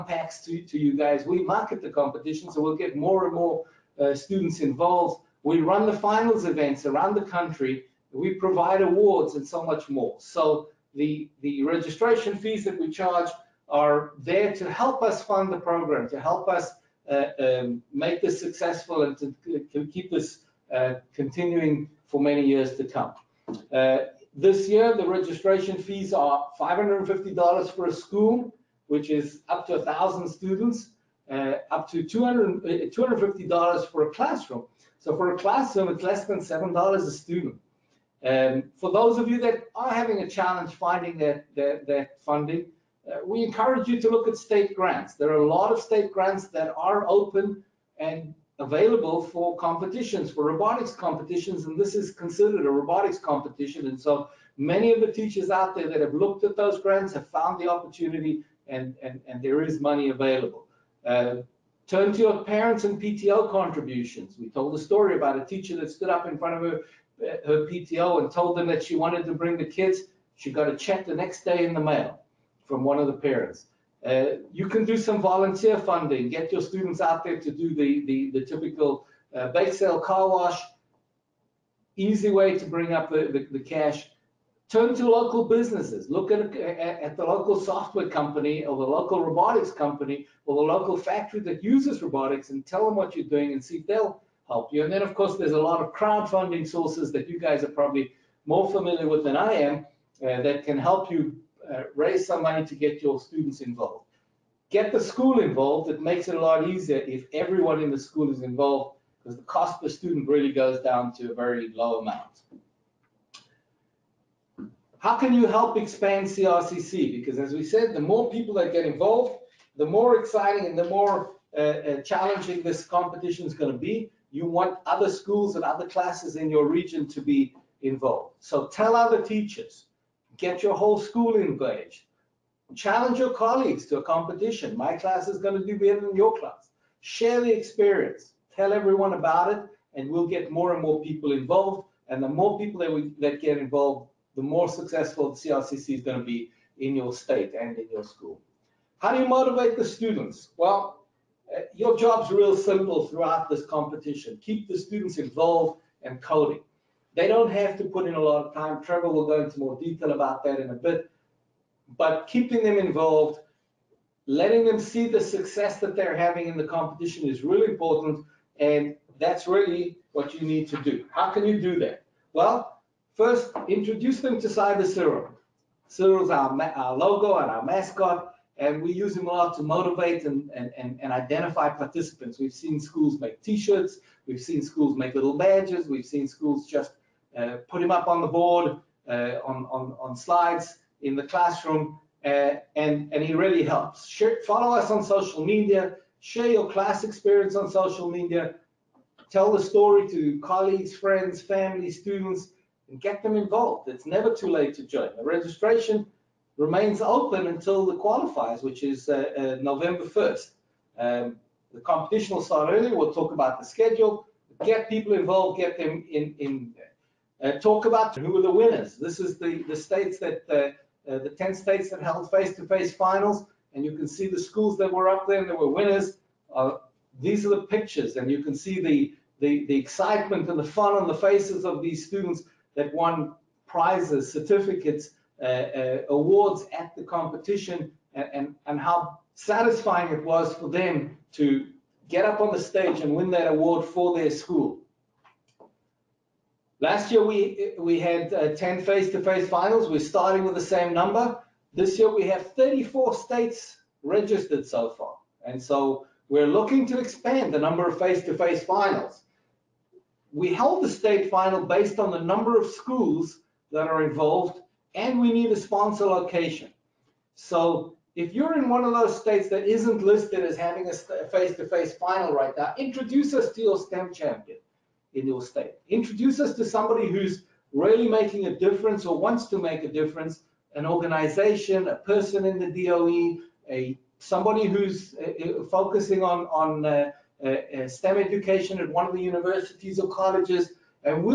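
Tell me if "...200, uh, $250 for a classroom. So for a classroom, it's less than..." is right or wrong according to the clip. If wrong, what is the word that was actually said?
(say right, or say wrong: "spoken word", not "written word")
right.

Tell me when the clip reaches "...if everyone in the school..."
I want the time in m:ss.
1:46.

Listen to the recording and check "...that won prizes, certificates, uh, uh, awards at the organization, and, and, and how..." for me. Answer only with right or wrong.
wrong.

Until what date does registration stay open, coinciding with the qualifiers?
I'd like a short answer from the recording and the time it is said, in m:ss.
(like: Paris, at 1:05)
November 1st, at 3:29.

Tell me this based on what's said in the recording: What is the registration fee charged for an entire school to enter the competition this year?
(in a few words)
$550.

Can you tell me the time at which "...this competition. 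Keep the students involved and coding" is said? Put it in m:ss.
2:33.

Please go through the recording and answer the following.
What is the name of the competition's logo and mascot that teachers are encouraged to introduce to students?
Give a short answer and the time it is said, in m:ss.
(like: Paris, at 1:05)
Cyber Cyril, at 2:54.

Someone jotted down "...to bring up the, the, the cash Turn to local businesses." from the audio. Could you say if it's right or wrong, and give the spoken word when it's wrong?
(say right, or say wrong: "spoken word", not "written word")
right.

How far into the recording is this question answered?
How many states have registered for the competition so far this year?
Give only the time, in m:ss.
4:12.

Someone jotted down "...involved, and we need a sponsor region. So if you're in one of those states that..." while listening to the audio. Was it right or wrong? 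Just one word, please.
wrong.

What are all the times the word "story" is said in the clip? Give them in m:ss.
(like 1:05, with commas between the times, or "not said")
1:04, 3:19.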